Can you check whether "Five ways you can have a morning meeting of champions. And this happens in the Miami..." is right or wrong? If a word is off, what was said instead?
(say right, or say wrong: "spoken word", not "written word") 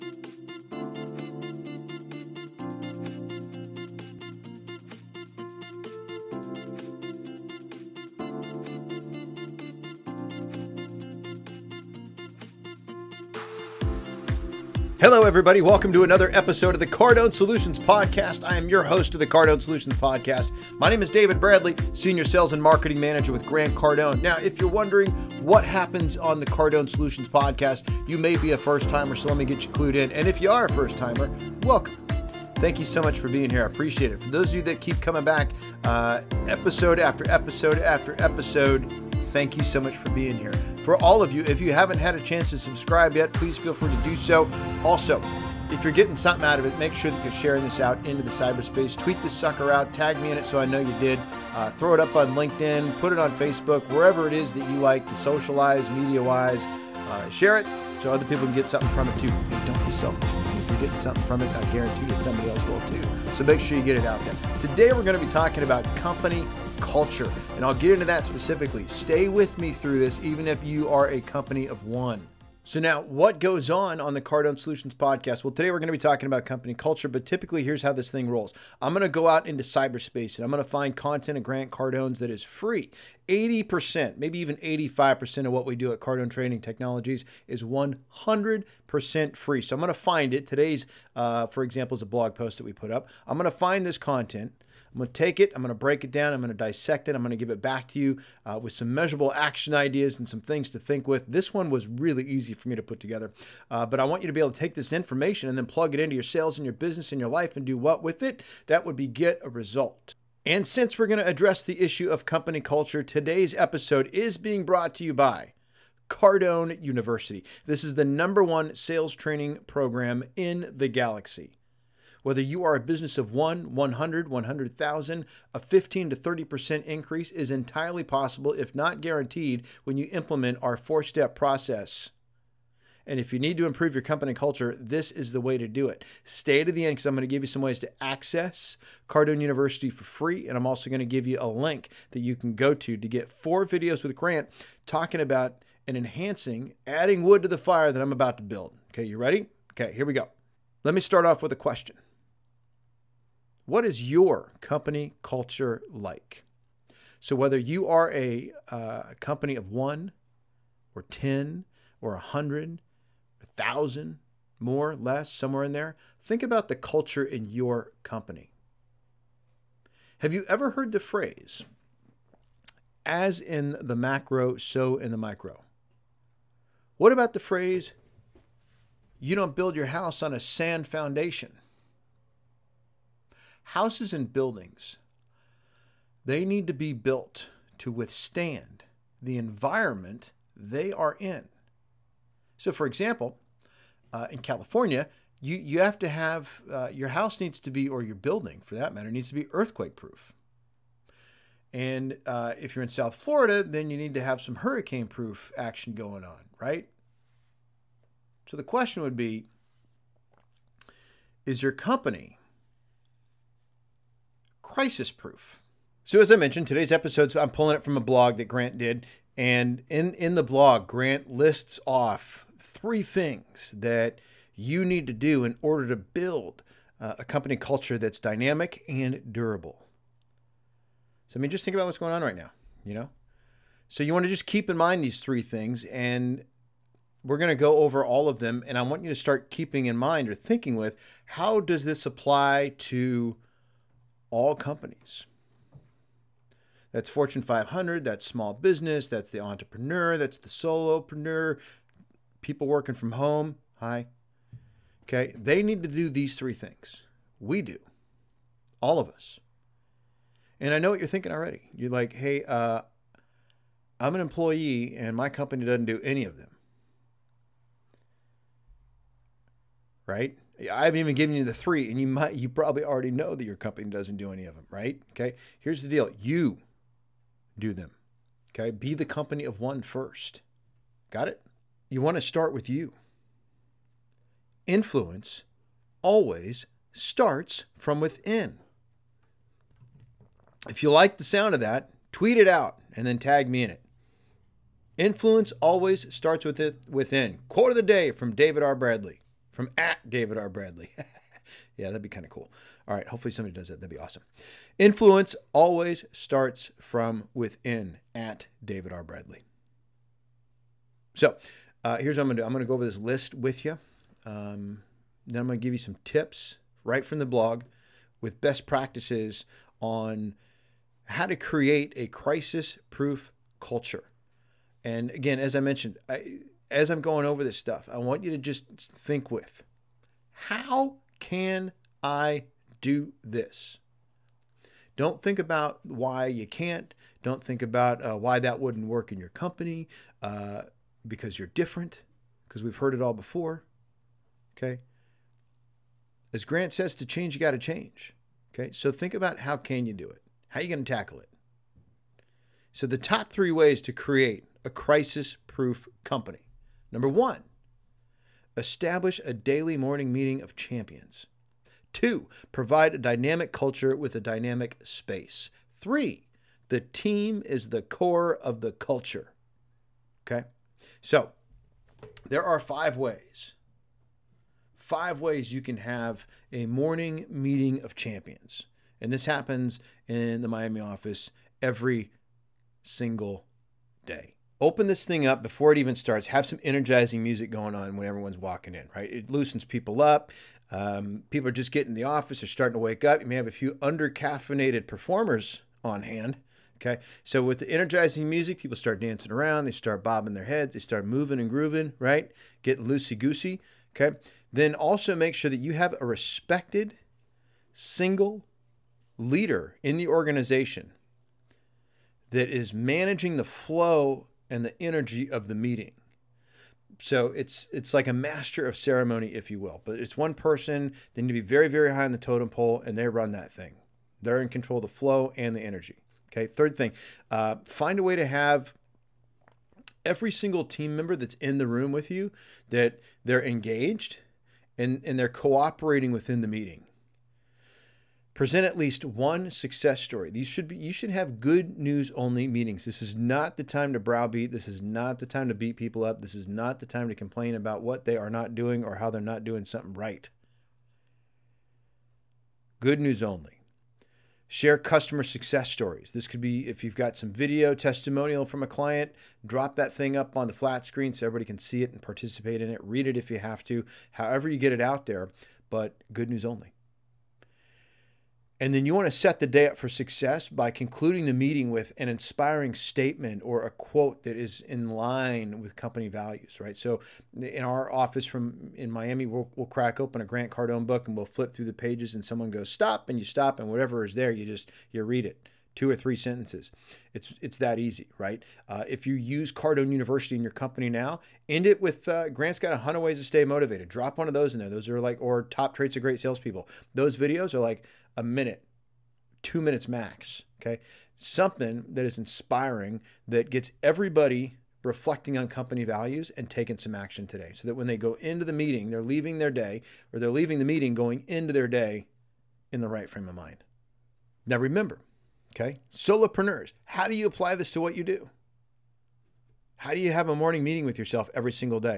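right.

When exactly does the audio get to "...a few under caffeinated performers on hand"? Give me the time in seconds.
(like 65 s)
393 s.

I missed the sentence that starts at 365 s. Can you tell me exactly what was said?
Three, the team is the core of the culture.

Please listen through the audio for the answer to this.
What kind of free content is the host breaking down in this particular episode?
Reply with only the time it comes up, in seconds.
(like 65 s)
92 s.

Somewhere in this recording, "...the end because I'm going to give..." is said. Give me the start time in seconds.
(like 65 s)
136 s.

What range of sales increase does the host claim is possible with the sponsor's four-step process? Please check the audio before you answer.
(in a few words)
15 to 30%.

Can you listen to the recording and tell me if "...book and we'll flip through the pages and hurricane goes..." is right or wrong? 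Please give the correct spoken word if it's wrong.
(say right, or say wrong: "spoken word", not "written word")
wrong: "someone", not "hurricane".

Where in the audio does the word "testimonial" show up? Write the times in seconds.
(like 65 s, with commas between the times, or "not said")
457 s.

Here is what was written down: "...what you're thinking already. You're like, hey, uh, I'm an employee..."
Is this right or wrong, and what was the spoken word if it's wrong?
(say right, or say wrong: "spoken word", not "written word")
right.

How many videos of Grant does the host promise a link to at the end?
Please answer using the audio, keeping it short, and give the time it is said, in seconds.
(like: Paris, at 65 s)
4, at 143 s.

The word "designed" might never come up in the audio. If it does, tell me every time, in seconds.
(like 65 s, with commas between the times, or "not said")
not said.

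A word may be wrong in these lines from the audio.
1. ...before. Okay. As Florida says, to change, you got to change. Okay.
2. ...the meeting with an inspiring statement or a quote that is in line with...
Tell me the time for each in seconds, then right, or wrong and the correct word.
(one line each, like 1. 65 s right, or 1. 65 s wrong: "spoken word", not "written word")
1. 343 s wrong: "Grant", not "Florida"
2. 471 s right.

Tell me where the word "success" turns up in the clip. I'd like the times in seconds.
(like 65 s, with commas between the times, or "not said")
439 s, 455 s, 469 s.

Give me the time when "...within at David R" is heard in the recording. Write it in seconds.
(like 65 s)
307 s.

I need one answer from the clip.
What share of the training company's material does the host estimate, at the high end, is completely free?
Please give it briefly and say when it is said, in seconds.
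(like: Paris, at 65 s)
85%, at 84 s.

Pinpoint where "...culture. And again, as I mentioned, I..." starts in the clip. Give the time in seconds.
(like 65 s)
323 s.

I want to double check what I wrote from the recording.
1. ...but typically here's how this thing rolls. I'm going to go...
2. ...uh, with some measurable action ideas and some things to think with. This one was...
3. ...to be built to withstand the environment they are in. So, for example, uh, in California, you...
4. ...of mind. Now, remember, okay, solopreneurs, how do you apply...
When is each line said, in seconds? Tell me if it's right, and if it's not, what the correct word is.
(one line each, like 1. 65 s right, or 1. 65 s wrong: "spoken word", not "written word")
1. 77 s right
2. 98 s right
3. 186 s right
4. 513 s right.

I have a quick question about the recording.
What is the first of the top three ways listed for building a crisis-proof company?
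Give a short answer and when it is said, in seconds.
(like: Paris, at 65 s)
Daily morning meeting of champions, at 359 s.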